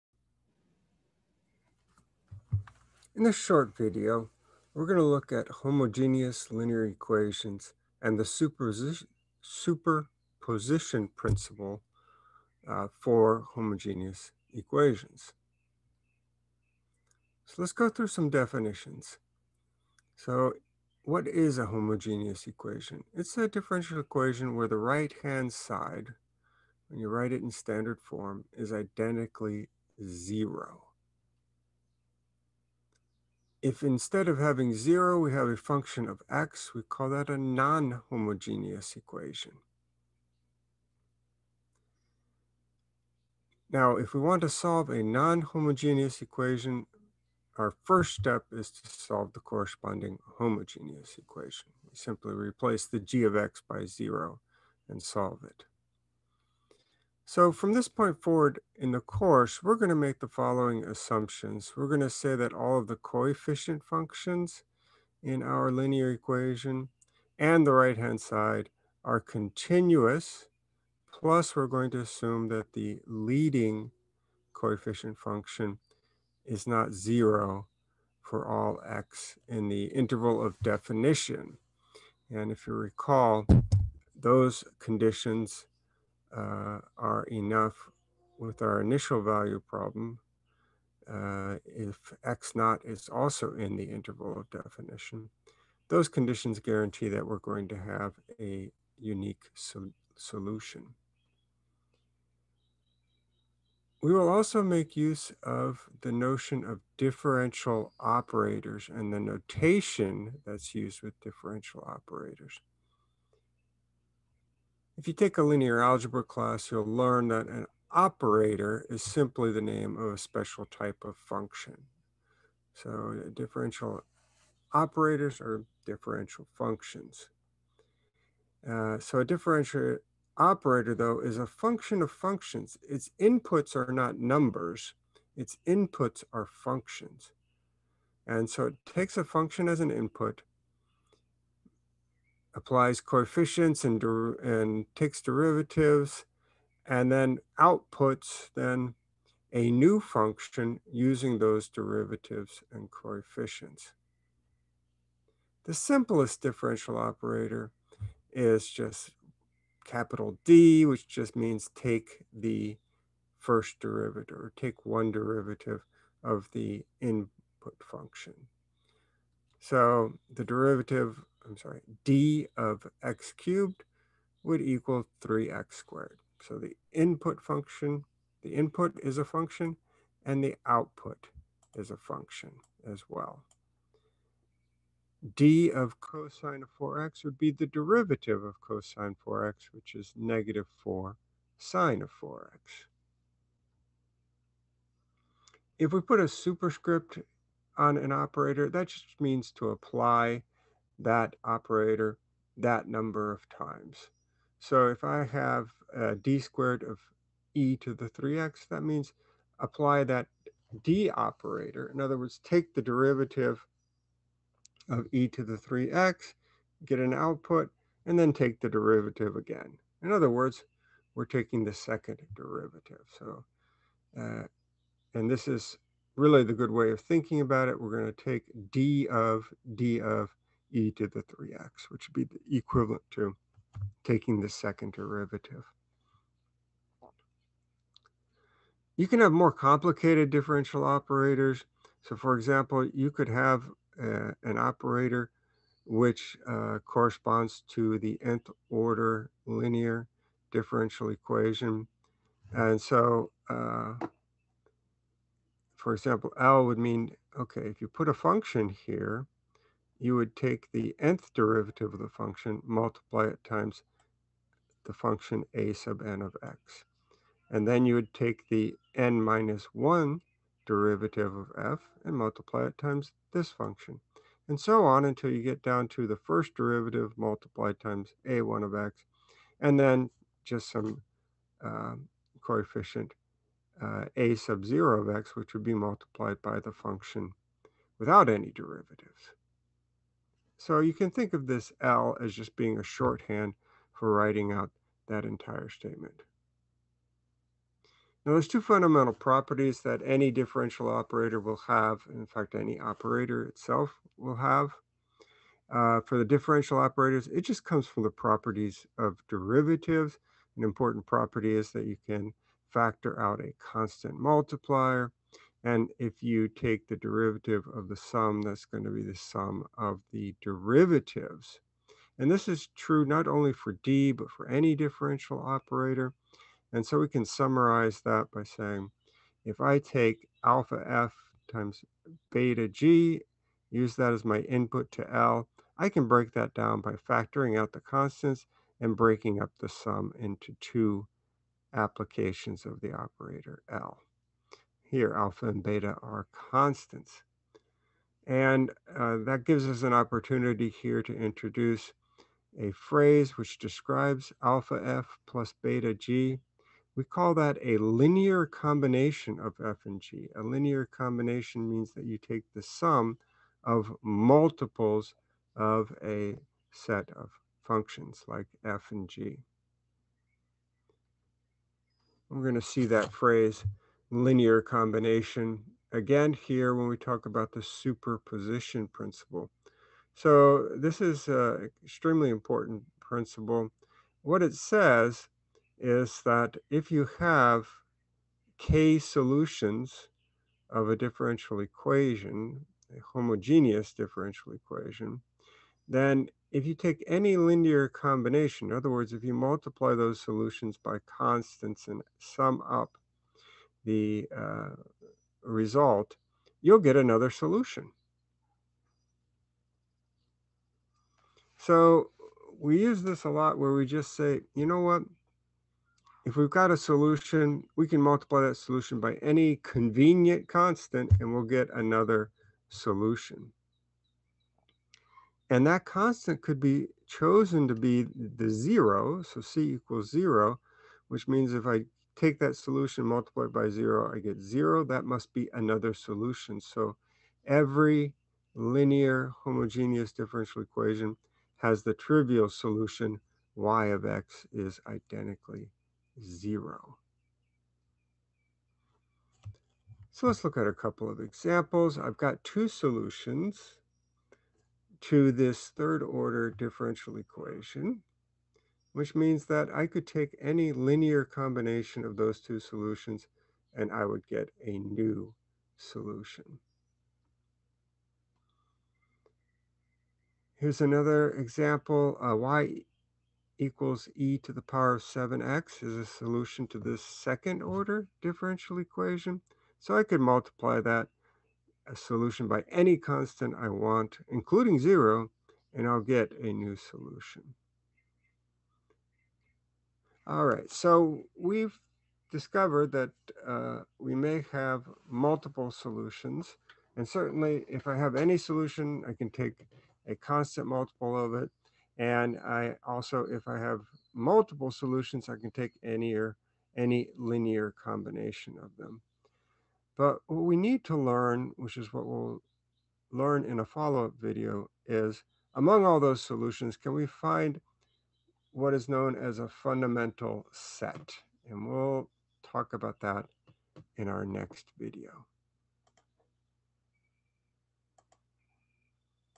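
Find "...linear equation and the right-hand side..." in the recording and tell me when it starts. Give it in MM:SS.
01:05.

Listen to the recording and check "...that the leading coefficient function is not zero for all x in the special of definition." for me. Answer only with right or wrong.
wrong.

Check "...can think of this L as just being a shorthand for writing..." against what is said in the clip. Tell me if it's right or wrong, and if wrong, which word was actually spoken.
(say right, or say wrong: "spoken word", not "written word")
right.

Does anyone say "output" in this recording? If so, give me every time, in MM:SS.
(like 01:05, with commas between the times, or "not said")
02:27, 03:00, 03:37.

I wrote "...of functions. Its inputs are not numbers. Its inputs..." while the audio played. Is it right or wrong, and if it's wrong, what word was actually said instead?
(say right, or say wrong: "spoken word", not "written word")
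right.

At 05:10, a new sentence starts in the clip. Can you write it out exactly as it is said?
An important property is that you can factor out a constant multiplier.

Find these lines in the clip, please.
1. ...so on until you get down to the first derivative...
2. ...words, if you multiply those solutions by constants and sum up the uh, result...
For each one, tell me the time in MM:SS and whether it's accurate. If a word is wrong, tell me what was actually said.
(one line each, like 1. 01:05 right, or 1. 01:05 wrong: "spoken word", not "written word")
1. 04:34 right
2. 06:38 right.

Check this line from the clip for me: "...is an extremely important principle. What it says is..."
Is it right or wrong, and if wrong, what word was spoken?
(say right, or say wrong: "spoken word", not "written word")
right.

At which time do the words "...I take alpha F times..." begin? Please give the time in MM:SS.
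05:29.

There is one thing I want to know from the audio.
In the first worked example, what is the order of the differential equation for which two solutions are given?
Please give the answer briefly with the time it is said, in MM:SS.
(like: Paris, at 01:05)
third order, at 07:35.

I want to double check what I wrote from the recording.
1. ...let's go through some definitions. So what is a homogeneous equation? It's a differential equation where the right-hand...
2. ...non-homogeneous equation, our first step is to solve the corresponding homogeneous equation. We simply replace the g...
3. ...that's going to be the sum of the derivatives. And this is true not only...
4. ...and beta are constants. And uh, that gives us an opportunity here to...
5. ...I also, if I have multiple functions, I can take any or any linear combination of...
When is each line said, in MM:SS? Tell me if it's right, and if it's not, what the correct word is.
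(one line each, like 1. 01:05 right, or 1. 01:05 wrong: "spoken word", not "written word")
1. 00:17 right
2. 00:45 right
3. 05:18 right
4. 05:45 right
5. 08:22 wrong: "solutions", not "functions".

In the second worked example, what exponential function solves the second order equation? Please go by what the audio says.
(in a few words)
e^(7x).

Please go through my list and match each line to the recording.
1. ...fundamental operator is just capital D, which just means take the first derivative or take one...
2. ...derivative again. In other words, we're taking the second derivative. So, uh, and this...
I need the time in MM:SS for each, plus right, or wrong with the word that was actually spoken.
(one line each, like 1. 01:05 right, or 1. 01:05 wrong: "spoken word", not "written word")
1. 02:36 wrong: "differential", not "fundamental"
2. 03:38 right.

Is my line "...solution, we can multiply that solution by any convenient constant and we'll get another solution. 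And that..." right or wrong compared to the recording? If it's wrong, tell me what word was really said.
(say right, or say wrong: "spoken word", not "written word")
right.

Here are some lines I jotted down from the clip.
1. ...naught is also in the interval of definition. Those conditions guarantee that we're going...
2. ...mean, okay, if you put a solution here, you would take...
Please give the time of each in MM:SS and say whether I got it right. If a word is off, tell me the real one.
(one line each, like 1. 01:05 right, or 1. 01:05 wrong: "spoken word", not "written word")
1. 01:32 right
2. 04:16 wrong: "function", not "solution".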